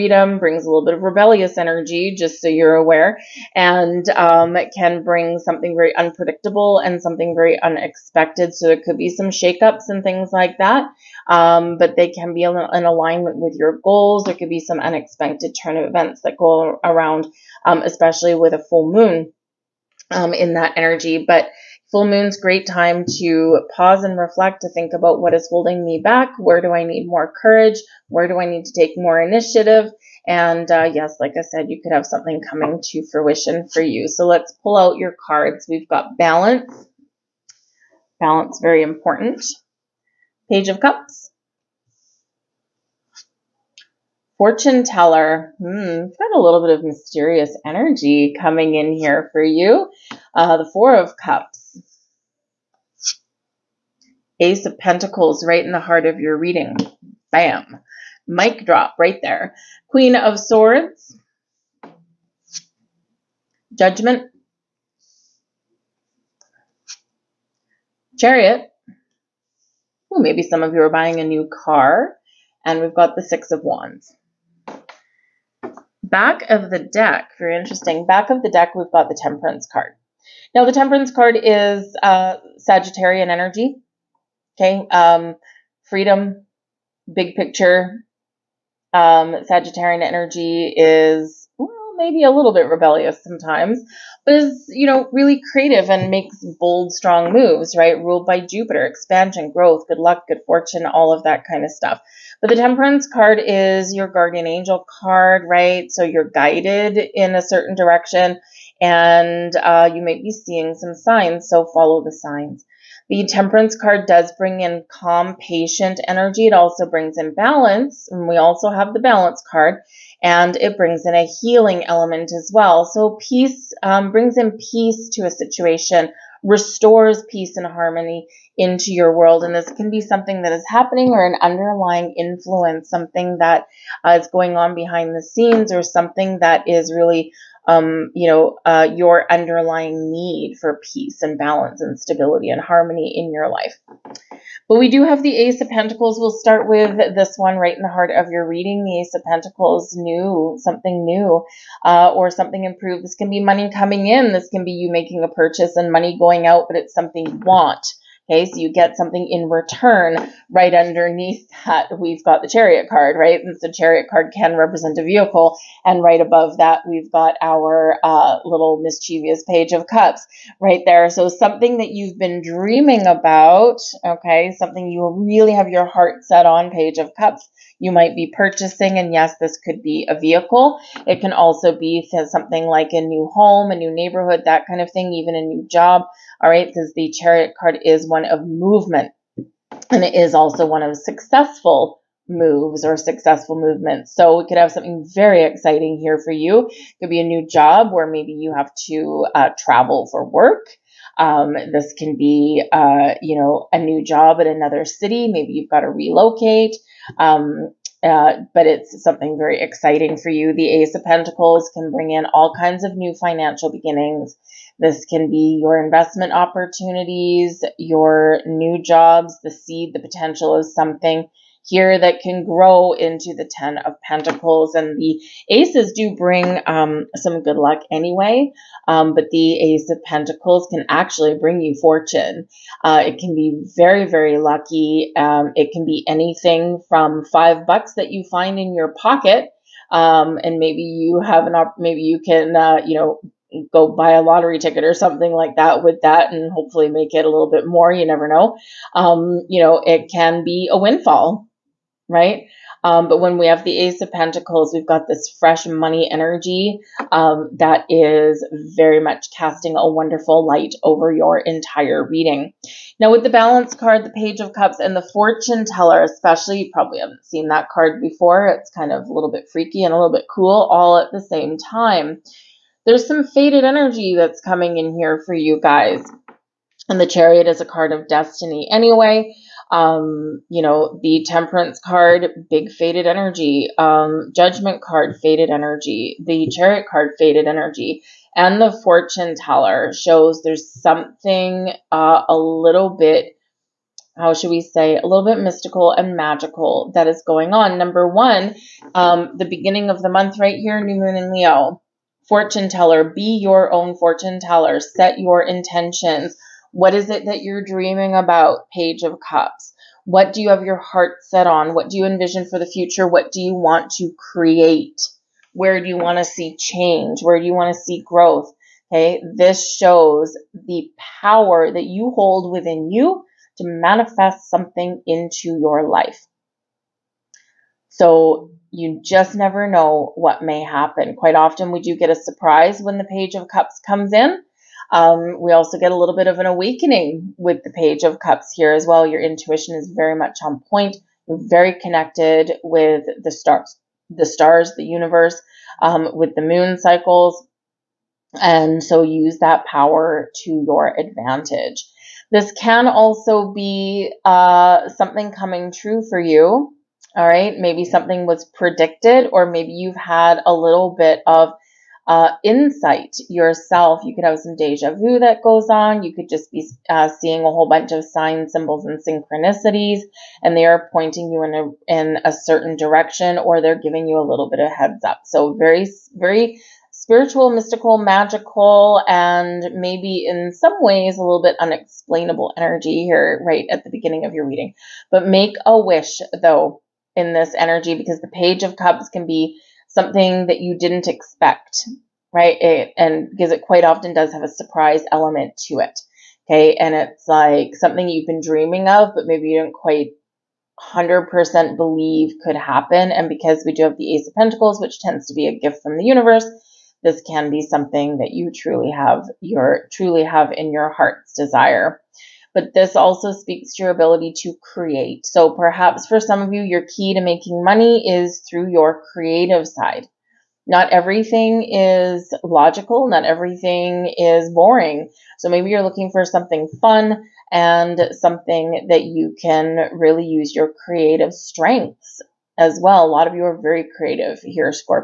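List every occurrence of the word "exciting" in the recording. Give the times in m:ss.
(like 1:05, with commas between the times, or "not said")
3:15, 3:29.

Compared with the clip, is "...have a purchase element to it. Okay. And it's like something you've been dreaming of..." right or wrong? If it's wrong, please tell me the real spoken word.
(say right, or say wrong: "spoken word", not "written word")
wrong: "surprise", not "purchase".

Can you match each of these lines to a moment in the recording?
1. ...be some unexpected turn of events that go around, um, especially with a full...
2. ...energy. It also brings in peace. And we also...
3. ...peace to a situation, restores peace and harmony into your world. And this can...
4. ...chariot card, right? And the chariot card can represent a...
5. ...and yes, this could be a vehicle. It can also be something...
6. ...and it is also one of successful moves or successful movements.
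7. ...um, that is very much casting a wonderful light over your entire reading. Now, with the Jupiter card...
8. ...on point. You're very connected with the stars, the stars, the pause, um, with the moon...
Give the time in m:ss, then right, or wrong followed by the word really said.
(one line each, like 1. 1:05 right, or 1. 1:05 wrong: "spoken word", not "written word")
1. 0:14 right
2. 1:56 wrong: "balance", not "peace"
3. 2:04 right
4. 2:42 right
5. 2:58 right
6. 3:09 right
7. 4:17 wrong: "Balance", not "Jupiter"
8. 5:40 wrong: "universe", not "pause".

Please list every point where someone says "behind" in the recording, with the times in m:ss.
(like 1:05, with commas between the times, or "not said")
2:14.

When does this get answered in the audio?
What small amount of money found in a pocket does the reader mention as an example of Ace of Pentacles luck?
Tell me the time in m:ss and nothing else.
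3:57.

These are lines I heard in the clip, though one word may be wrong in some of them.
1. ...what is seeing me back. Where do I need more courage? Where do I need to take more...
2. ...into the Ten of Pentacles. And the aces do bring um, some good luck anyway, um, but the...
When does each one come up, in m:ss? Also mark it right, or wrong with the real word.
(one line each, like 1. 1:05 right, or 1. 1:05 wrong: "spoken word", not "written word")
1. 0:25 wrong: "holding", not "seeing"
2. 3:42 right.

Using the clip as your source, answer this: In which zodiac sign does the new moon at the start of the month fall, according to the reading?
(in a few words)
Leo.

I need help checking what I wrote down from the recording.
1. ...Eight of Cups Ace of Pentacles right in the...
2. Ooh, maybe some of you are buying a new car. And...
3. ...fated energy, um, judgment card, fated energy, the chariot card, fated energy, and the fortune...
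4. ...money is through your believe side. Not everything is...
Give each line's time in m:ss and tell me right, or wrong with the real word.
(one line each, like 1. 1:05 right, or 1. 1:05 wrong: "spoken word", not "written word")
1. 0:50 wrong: "Four", not "Eight"
2. 1:10 right
3. 4:42 right
4. 6:57 wrong: "creative", not "believe".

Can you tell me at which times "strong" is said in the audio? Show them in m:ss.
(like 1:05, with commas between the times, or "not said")
1:36.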